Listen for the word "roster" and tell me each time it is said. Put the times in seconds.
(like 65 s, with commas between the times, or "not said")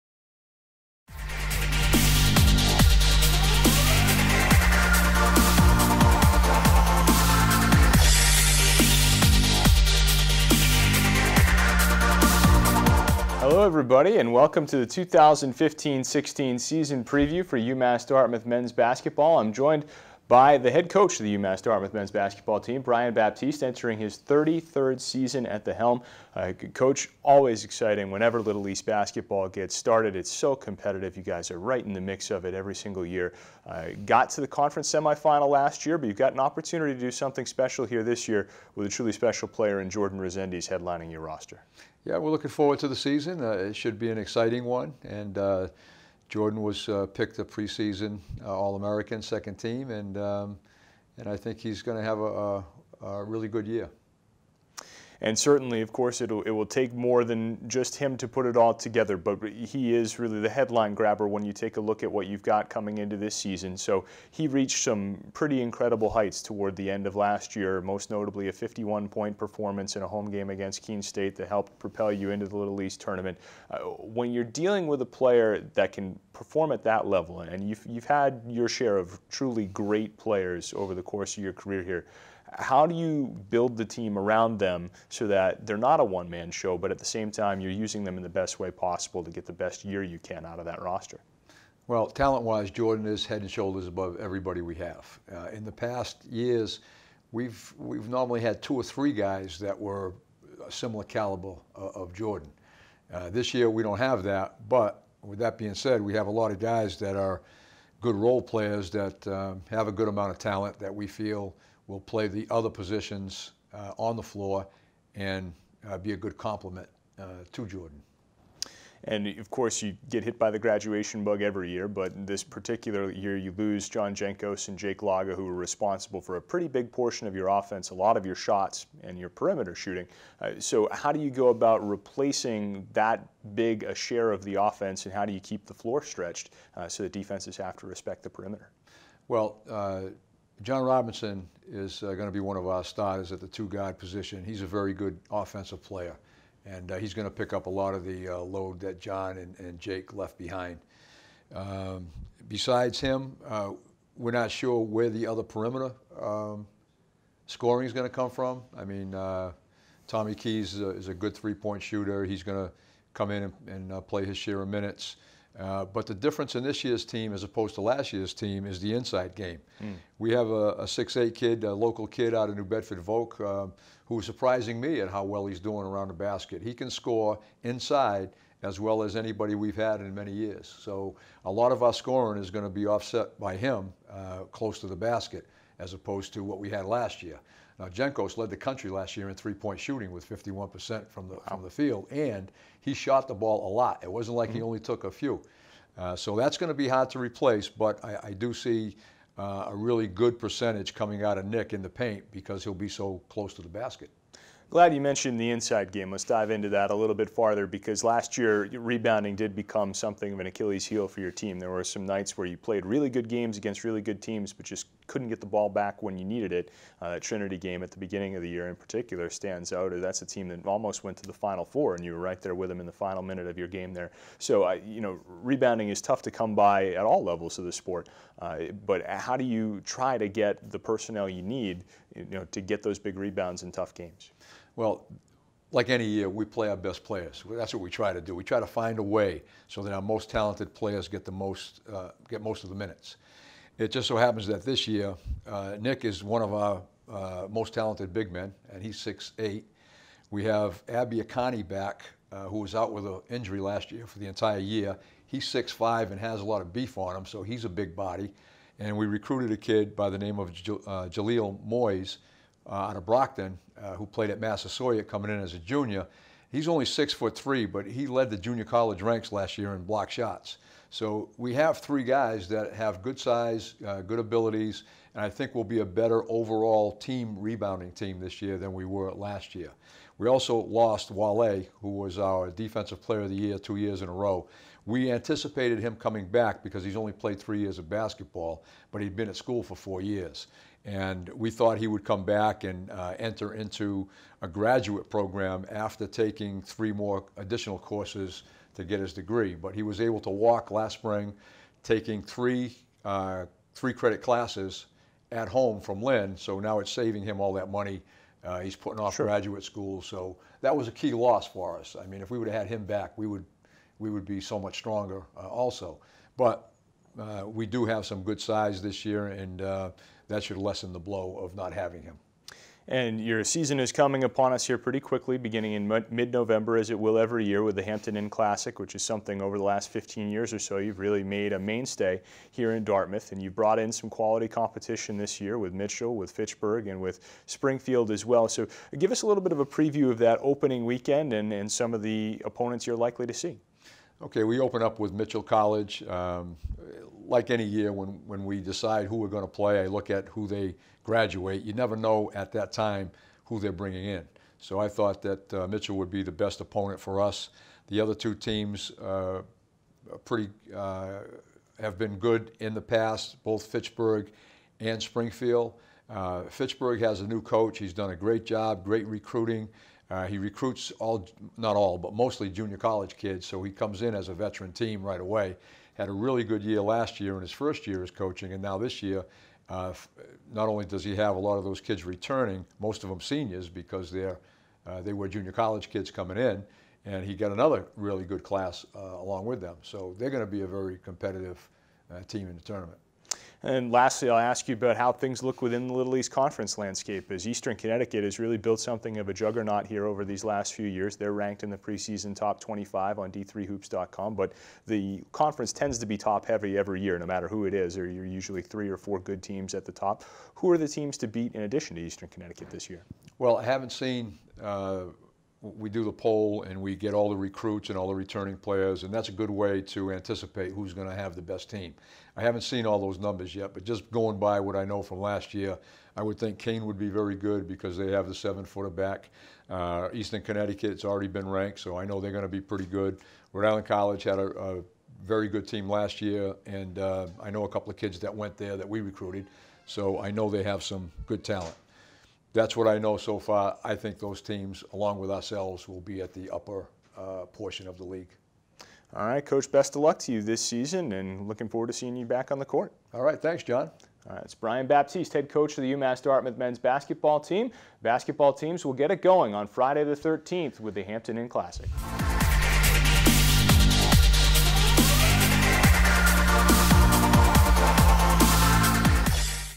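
41 s, 90 s.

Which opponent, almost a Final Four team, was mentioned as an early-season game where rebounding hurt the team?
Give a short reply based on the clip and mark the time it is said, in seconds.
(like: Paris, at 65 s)
Trinity, at 217 s.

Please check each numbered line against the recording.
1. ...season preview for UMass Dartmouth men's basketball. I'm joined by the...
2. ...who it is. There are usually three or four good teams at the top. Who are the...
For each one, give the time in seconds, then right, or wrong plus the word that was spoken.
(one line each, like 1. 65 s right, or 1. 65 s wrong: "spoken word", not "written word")
1. 16 s right
2. 407 s right.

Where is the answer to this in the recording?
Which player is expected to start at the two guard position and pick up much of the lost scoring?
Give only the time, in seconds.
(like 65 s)
140 s.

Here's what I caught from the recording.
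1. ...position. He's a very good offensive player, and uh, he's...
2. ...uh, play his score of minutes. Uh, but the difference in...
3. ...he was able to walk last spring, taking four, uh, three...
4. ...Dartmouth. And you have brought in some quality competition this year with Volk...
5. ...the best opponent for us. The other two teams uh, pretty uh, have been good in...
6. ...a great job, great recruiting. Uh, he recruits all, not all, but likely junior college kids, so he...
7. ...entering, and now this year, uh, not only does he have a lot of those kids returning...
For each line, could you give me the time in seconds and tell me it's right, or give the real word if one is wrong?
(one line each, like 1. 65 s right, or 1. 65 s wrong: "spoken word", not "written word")
1. 143 s right
2. 163 s wrong: "share", not "score"
3. 299 s wrong: "three", not "four"
4. 332 s wrong: "Mitchell", not "Volk"
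5. 356 s right
6. 368 s wrong: "mostly", not "likely"
7. 378 s wrong: "coaching", not "entering".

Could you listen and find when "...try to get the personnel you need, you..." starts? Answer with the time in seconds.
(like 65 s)
229 s.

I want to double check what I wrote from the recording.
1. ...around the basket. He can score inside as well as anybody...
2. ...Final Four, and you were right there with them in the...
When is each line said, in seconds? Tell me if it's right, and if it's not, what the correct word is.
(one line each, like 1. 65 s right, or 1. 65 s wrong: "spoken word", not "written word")
1. 175 s right
2. 221 s right.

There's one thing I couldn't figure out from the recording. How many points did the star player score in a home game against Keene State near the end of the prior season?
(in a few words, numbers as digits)
51.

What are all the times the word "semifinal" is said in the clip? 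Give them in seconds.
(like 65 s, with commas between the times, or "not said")
34 s.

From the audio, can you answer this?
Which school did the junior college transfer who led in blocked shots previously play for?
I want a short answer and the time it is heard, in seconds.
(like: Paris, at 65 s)
Massasoit, at 264 s.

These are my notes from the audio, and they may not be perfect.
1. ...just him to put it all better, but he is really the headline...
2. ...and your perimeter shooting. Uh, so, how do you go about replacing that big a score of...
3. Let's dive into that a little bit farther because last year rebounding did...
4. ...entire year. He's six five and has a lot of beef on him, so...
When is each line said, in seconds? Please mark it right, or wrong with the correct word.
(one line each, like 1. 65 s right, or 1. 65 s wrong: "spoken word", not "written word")
1. 57 s wrong: "together", not "better"
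2. 129 s wrong: "share", not "score"
3. 206 s right
4. 254 s right.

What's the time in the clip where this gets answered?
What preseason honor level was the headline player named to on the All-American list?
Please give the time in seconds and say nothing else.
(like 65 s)
49 s.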